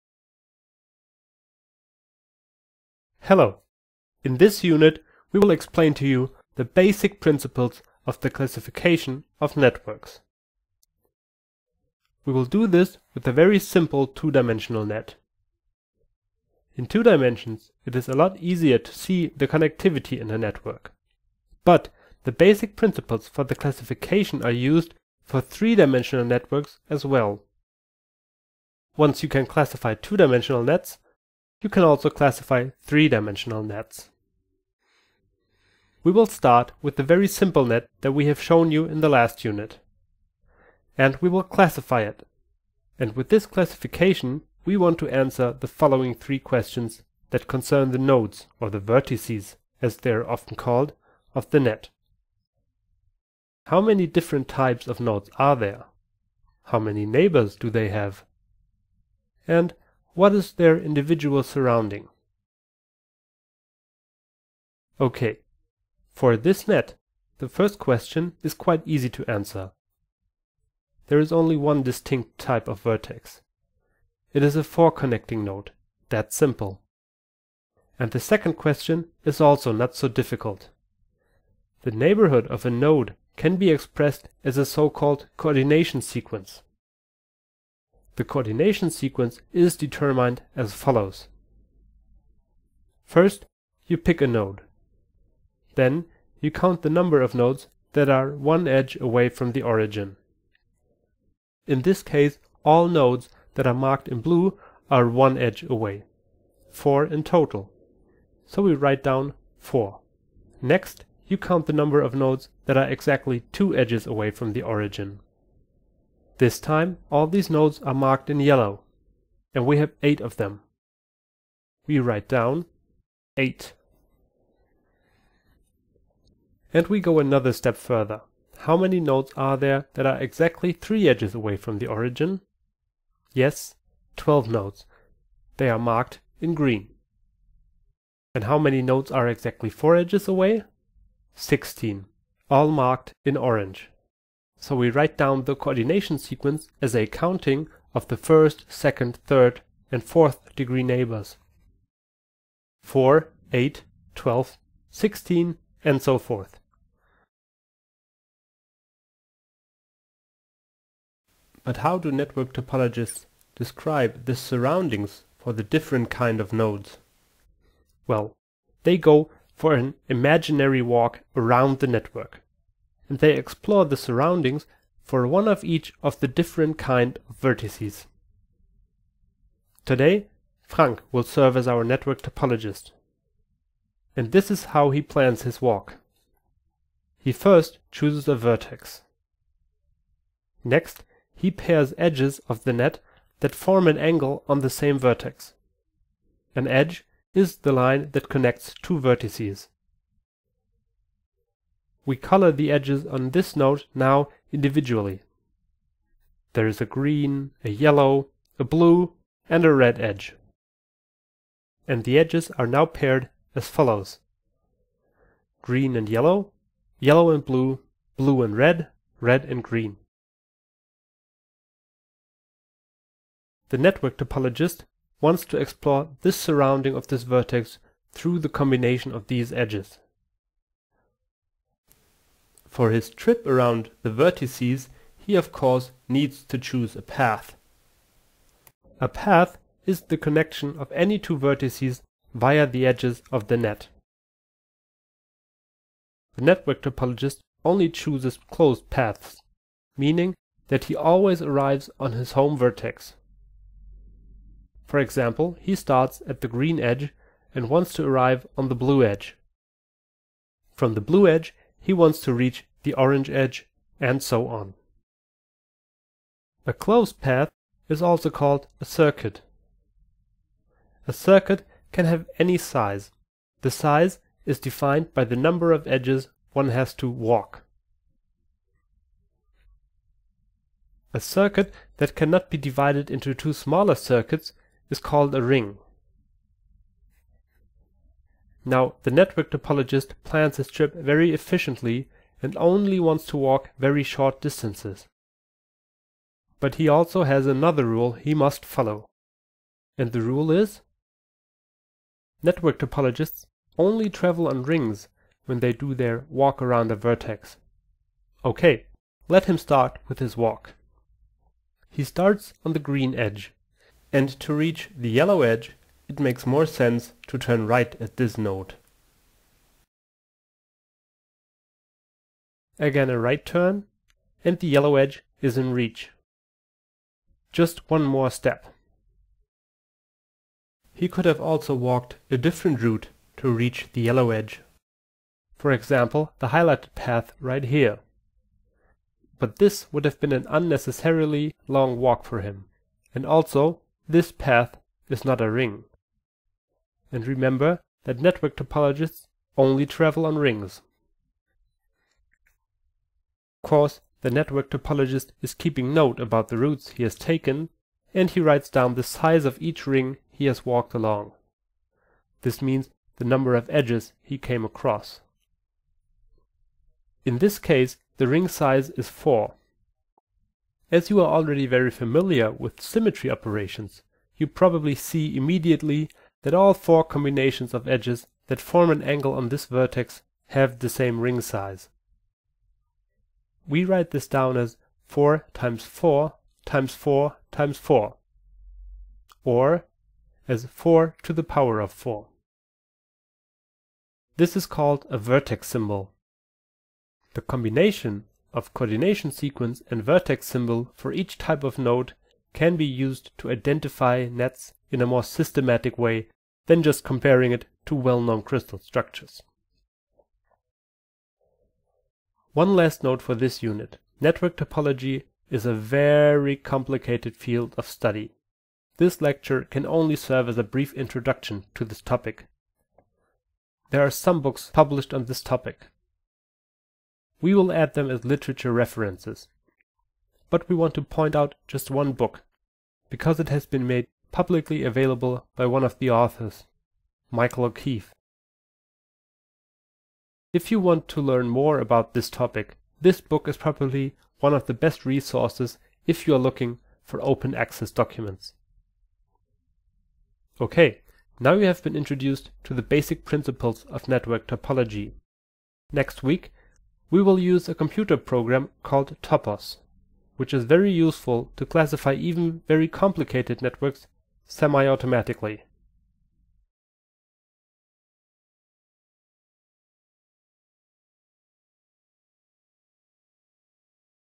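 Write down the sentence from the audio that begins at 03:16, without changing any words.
An edge is the line that connects two vertices.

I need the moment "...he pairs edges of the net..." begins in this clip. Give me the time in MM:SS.
03:11.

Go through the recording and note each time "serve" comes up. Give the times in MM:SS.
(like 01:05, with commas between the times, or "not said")
03:01, 07:00.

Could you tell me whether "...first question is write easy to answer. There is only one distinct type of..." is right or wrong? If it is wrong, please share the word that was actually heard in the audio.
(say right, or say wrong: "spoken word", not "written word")
wrong: "quite", not "write".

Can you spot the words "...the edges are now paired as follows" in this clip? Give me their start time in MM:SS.
03:32.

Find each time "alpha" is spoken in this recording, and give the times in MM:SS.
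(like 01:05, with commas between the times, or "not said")
not said.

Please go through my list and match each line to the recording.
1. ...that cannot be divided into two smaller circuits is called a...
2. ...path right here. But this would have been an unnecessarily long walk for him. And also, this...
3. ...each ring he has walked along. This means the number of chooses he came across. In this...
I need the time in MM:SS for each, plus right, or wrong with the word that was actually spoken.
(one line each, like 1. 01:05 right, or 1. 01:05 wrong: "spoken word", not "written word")
1. 04:41 right
2. 05:36 right
3. 05:59 wrong: "edges", not "chooses".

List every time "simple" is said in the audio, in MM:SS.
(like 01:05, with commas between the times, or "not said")
00:13, 00:37, 01:16.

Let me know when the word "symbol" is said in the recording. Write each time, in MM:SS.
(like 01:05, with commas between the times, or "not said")
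06:35, 06:40.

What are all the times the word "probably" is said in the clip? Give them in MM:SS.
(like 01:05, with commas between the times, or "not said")
06:14, 07:23.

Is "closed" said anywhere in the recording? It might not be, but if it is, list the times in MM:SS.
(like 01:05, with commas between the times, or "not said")
04:08, 04:26.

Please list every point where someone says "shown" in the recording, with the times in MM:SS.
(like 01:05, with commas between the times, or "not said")
00:38.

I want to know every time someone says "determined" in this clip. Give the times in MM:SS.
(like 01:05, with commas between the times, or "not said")
01:29.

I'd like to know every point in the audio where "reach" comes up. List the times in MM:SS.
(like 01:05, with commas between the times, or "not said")
04:22, 05:14, 05:25, 05:33.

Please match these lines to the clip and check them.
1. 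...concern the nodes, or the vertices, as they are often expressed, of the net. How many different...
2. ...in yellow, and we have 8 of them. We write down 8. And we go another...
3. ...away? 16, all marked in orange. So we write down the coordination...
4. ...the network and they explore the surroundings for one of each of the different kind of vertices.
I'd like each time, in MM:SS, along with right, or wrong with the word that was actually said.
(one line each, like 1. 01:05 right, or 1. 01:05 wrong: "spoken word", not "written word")
1. 00:47 wrong: "called", not "expressed"
2. 01:58 right
3. 02:20 right
4. 02:51 right.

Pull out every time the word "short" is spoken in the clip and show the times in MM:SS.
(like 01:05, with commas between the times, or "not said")
04:54.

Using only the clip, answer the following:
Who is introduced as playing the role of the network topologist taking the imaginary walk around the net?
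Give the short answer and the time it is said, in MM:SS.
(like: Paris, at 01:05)
Frank, at 03:00.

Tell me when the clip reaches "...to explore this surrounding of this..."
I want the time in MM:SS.
03:45.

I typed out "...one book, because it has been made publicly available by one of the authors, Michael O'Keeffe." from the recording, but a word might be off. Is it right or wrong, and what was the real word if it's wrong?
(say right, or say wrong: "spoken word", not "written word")
right.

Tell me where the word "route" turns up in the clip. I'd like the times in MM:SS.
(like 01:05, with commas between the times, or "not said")
05:32, 05:56.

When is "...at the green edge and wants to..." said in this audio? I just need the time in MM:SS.
04:16.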